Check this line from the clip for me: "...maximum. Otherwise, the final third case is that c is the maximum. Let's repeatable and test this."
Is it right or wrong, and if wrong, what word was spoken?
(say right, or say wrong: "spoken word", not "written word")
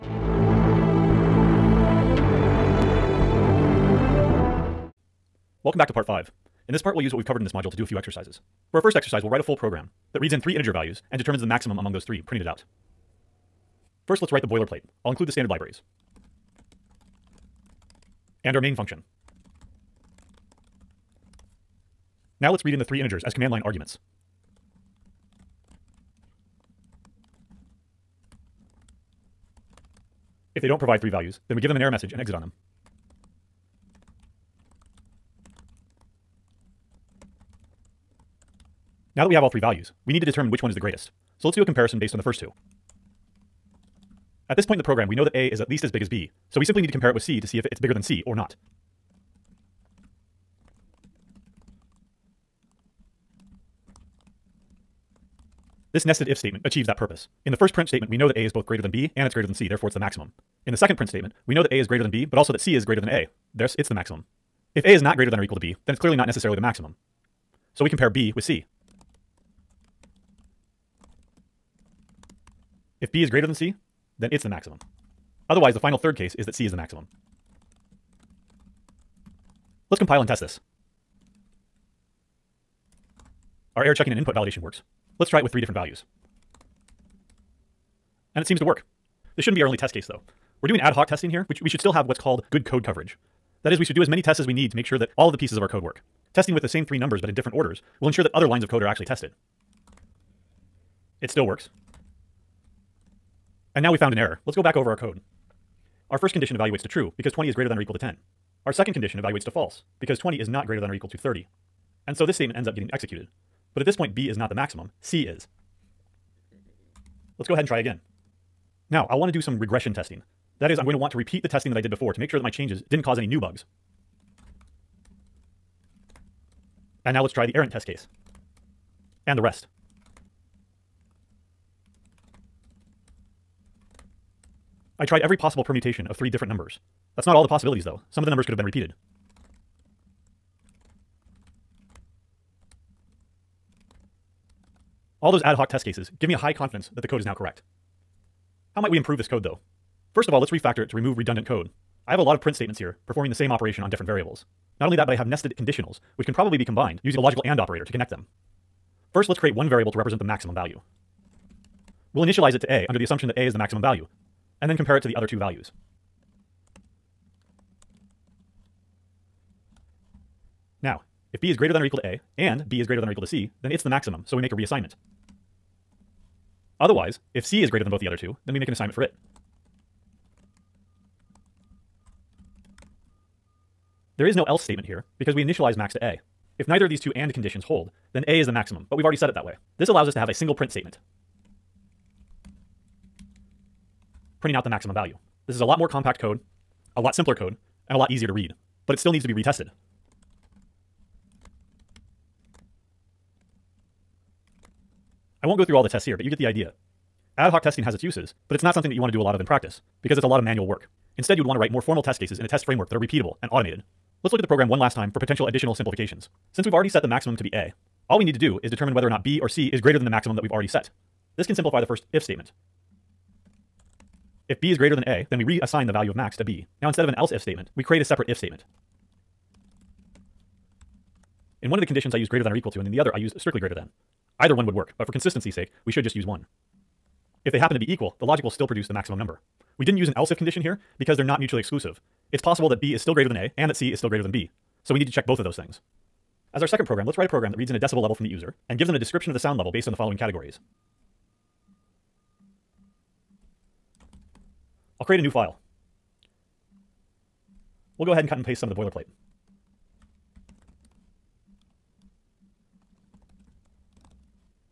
wrong: "compile", not "repeatable".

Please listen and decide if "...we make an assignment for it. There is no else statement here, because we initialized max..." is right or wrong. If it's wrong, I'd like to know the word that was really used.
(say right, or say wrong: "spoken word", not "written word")
right.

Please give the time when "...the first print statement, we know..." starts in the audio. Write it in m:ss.
0:57.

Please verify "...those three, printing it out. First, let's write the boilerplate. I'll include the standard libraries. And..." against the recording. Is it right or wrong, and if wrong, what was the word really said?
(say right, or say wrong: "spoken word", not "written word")
right.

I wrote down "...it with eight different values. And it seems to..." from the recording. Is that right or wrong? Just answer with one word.
wrong.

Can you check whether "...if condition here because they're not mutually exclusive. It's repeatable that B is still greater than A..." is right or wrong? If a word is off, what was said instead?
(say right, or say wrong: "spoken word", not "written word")
wrong: "possible", not "repeatable".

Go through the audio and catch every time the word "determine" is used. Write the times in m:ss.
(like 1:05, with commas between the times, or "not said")
0:11, 0:40, 3:38.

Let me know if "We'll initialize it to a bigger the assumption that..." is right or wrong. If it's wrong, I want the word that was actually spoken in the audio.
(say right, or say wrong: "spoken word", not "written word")
wrong: "under", not "bigger".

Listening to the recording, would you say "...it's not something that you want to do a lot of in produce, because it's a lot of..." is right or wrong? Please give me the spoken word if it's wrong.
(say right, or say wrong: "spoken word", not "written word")
wrong: "practice", not "produce".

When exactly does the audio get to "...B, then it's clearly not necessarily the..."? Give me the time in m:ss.
1:05.